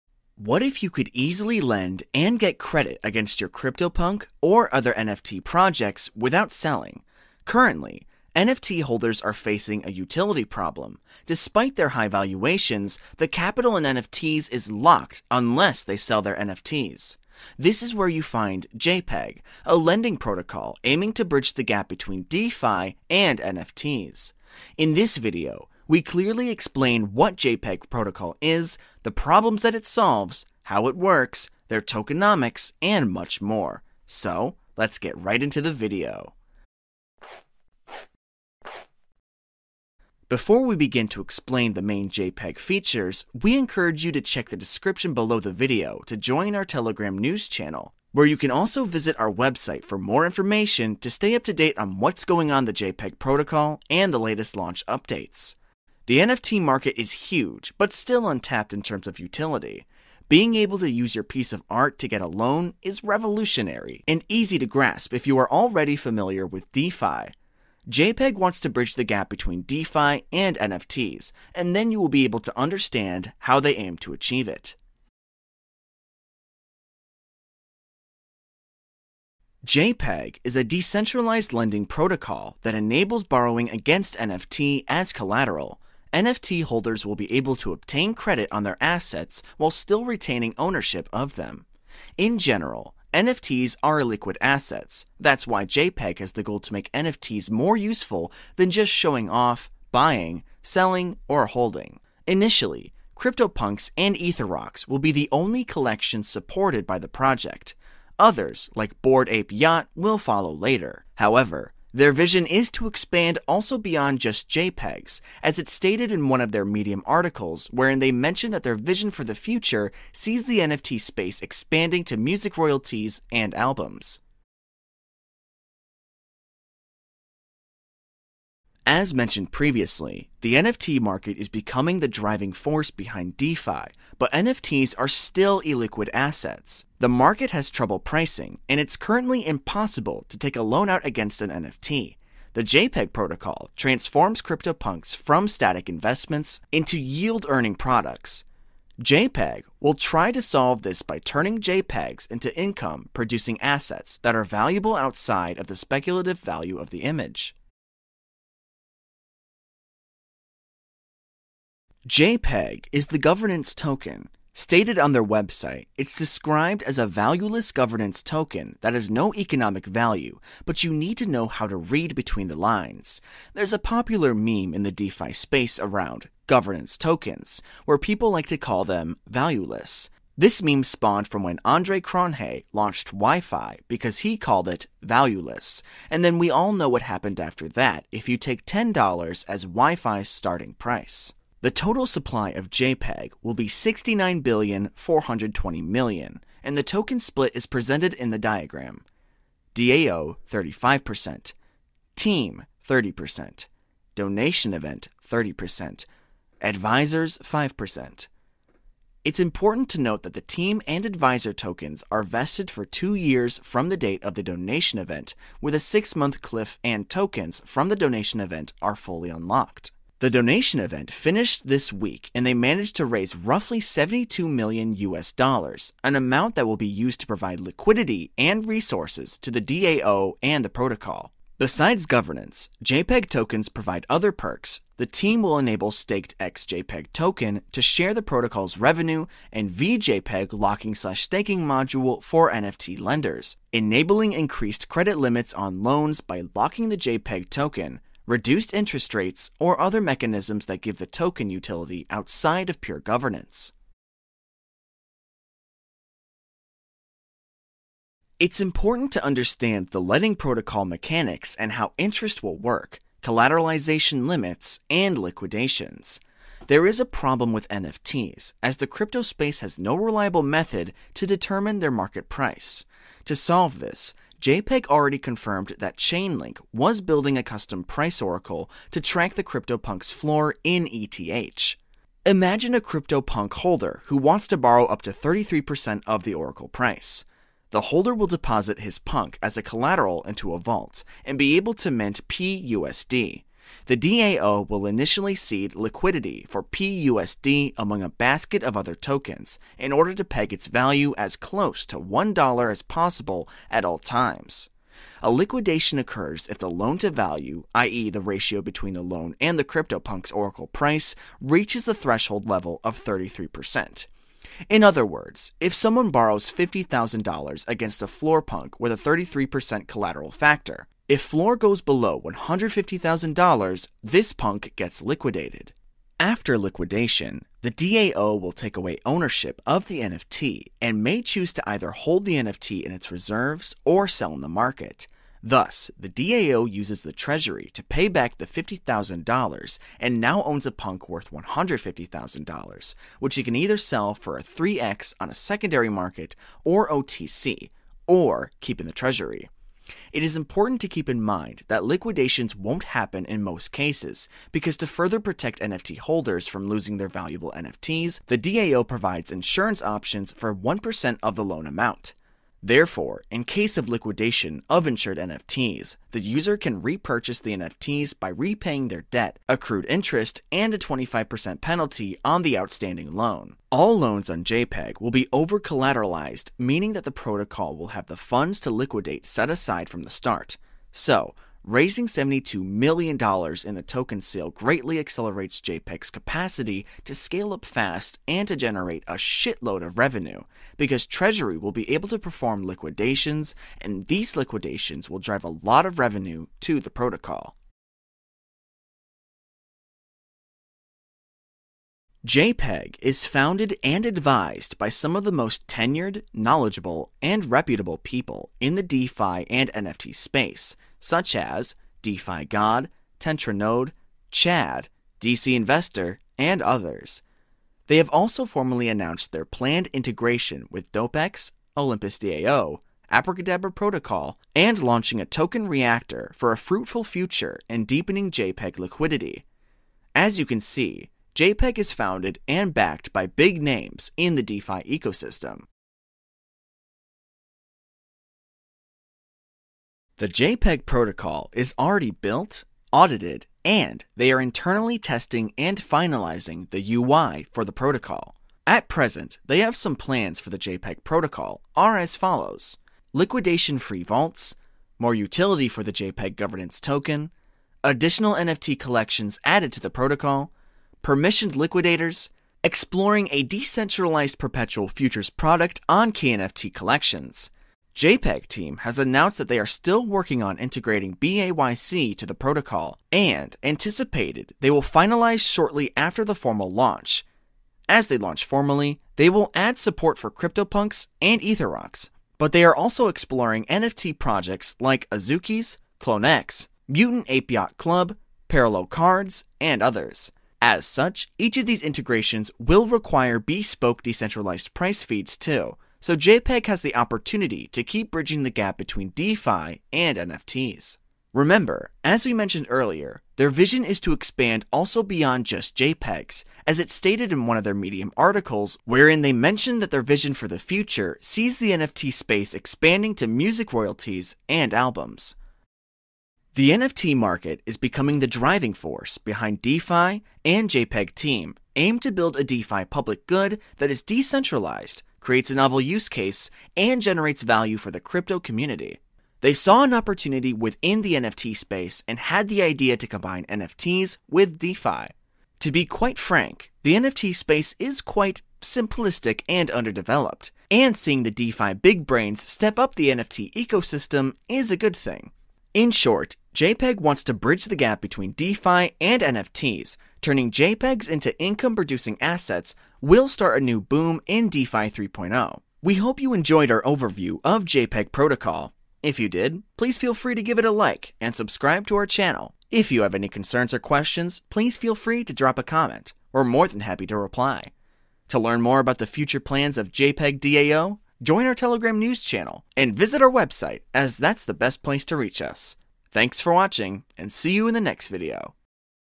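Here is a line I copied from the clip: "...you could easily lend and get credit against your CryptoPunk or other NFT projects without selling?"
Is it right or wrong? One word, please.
right.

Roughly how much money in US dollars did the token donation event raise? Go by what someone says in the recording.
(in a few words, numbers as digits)
72 million US dollars.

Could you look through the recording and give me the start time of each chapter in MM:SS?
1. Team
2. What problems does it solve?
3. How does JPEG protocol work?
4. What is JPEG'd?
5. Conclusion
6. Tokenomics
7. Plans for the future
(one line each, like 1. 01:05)
1. 06:38
2. 02:04
3. 04:13
4. 01:15
5. 08:36
6. 02:37
7. 07:15.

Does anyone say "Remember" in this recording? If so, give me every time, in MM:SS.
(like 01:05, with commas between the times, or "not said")
08:21.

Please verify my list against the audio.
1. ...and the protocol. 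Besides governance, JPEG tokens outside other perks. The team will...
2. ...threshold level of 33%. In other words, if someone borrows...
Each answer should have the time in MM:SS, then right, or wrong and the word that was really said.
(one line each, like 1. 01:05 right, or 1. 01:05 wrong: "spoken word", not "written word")
1. 03:50 wrong: "provide", not "outside"
2. 05:11 right.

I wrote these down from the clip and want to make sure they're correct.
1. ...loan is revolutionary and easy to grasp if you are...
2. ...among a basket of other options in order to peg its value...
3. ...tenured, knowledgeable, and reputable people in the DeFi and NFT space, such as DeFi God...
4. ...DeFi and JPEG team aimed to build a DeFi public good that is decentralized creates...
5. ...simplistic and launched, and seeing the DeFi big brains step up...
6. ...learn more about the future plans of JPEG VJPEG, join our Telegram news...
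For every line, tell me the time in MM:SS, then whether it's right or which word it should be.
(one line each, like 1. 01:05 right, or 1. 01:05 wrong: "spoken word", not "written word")
1. 01:02 right
2. 04:57 wrong: "tokens", not "options"
3. 06:45 right
4. 08:39 right
5. 08:58 wrong: "underdeveloped", not "launched"
6. 09:28 wrong: "DAO", not "VJPEG".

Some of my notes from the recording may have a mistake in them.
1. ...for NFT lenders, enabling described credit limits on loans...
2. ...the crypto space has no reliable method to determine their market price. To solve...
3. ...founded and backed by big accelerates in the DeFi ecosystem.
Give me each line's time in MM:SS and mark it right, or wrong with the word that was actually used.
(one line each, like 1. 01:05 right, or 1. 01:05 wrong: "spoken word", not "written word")
1. 04:02 wrong: "increased", not "described"
2. 04:28 right
3. 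07:11 wrong: "names", not "accelerates".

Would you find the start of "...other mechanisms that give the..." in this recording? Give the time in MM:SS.
04:09.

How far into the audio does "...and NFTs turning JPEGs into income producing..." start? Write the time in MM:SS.
09:08.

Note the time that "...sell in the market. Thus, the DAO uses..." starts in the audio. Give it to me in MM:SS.
05:34.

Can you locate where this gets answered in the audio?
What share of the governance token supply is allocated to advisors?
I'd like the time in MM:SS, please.
03:26.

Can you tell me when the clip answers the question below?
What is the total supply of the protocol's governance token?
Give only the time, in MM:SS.
03:13.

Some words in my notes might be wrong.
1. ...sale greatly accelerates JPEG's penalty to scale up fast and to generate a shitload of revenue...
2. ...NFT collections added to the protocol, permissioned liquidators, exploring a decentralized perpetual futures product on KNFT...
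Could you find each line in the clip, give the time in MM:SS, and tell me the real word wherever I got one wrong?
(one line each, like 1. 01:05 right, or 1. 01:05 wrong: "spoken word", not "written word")
1. 06:24 wrong: "capacity", not "penalty"
2. 07:38 right.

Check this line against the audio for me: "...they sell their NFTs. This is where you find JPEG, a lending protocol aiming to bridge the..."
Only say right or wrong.
right.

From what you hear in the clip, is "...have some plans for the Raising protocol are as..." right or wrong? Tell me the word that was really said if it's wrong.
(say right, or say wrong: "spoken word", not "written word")
wrong: "JPEG", not "Raising".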